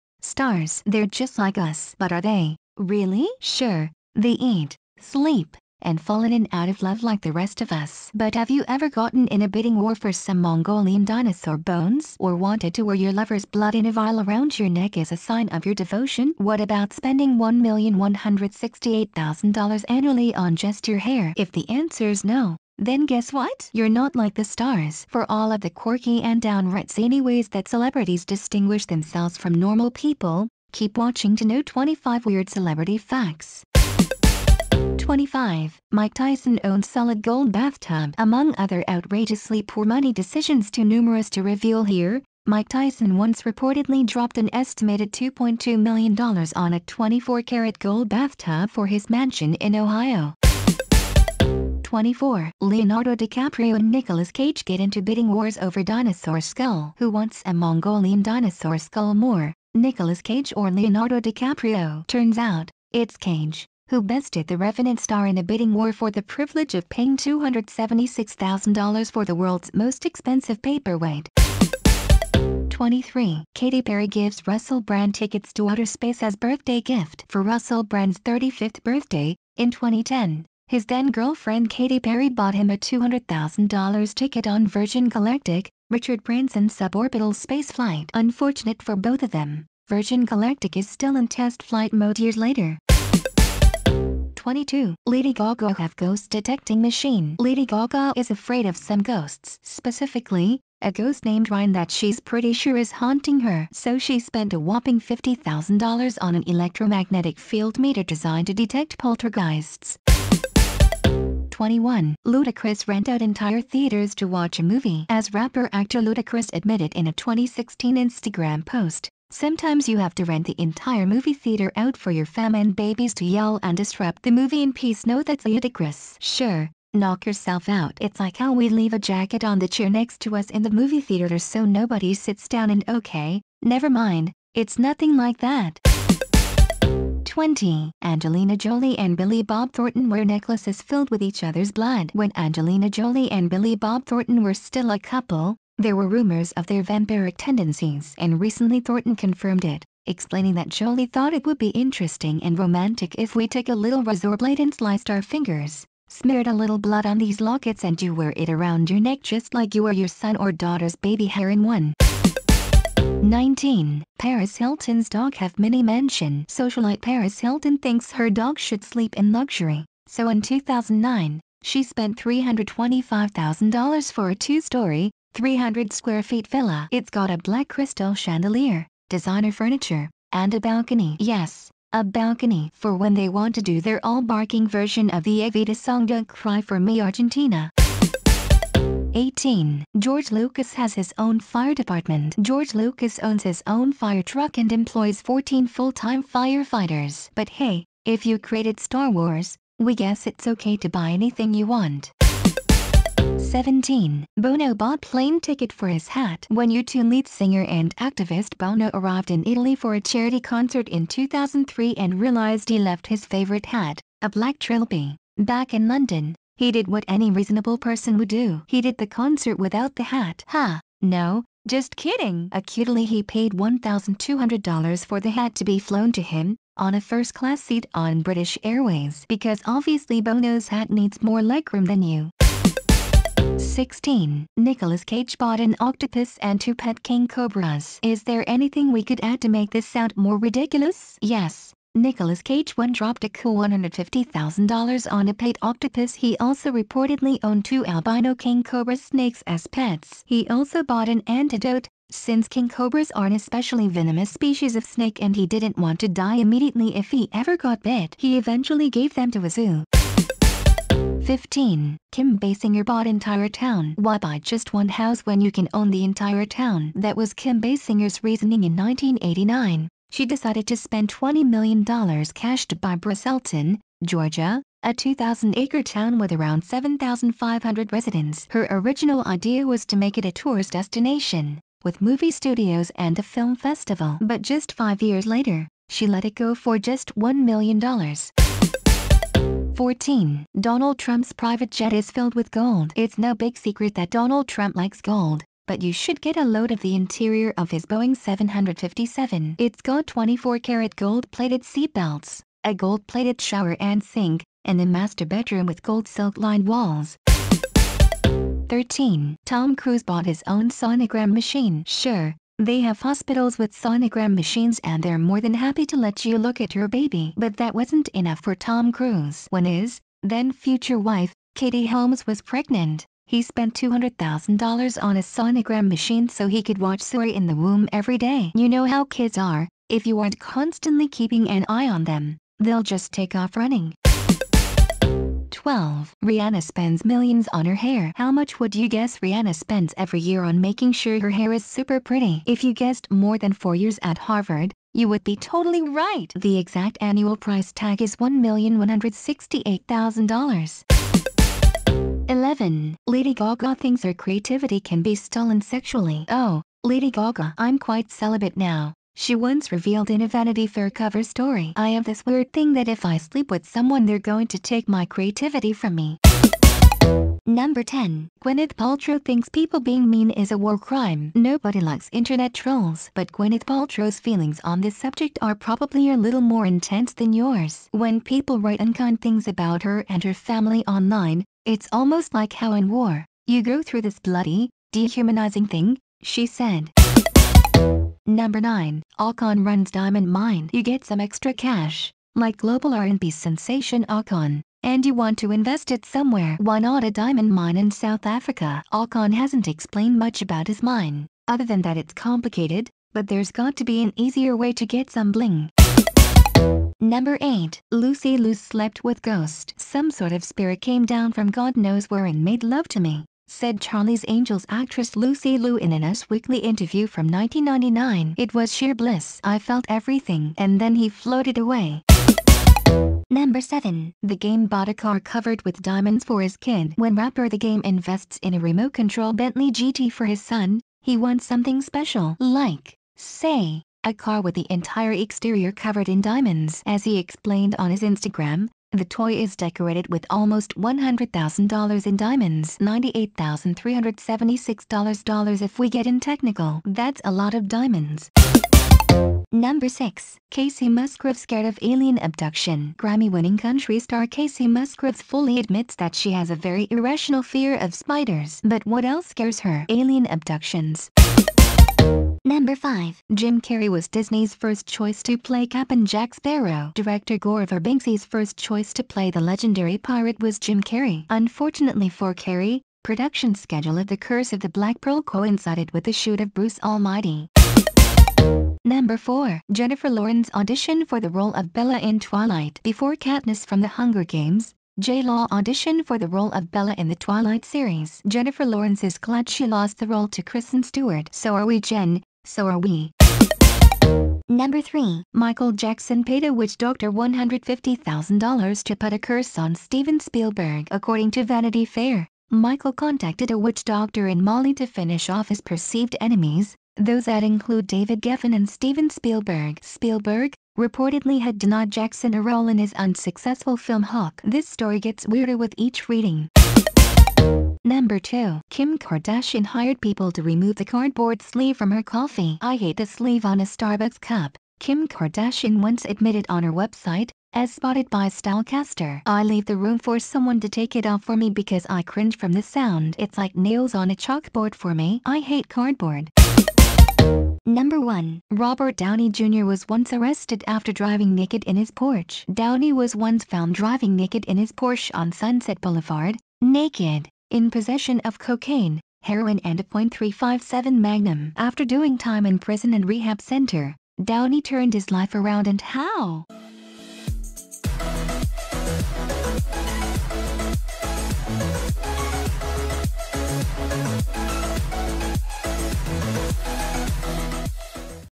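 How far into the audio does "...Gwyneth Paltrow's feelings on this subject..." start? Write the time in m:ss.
6:13.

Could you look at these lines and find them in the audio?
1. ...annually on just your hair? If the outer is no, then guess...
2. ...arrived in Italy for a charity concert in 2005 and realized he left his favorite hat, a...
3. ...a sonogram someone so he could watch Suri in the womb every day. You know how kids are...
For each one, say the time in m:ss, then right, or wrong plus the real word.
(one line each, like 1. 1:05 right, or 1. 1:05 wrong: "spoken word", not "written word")
1. 0:19 wrong: "answer", not "outer"
2. 3:28 wrong: "2003", not "2005"
3. 5:25 wrong: "machine", not "someone".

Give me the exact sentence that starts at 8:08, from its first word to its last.
Jennifer Lawrence is glad she lost the role to Kristen Stewart.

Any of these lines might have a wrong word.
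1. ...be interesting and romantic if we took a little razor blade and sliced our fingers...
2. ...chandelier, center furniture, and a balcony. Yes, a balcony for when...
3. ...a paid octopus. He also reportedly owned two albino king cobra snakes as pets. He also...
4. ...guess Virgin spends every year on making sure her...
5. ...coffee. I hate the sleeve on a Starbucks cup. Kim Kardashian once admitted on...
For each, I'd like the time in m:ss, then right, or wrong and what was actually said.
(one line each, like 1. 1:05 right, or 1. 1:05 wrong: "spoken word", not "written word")
1. 2:31 right
2. 2:58 wrong: "designer", not "center"
3. 4:05 right
4. 5:38 wrong: "Rihanna", not "Virgin"
5. 8:42 right.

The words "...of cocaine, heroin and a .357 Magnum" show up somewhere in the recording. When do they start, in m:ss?
9:08.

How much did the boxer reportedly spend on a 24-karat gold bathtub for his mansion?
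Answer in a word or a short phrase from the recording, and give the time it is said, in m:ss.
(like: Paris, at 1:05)
$2.2 million, at 0:45.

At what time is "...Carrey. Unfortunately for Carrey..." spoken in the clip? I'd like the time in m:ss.
7:50.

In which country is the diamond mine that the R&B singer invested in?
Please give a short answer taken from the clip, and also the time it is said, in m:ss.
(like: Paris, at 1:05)
South Africa, at 6:37.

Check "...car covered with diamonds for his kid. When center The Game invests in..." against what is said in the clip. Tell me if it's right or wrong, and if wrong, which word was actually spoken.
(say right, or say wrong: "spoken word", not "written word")
wrong: "rapper", not "center".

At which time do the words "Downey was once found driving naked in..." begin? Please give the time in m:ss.
9:02.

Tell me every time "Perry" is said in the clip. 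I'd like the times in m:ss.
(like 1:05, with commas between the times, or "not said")
1:13, 1:21.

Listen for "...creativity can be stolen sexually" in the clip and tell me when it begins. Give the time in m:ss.
5:54.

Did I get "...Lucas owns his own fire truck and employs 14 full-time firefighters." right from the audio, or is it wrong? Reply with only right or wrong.
right.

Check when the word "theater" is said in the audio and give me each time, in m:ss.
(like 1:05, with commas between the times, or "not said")
1:53, 2:01, 2:10.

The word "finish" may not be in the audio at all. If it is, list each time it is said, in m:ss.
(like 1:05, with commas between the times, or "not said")
8:24.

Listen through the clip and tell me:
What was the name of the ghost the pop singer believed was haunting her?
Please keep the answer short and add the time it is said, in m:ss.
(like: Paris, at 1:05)
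Ryan, at 1:41.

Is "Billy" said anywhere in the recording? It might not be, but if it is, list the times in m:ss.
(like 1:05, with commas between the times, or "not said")
2:19, 2:23.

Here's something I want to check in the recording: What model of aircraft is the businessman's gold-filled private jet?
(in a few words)
Boeing 757.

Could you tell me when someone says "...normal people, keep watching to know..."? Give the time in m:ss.
0:29.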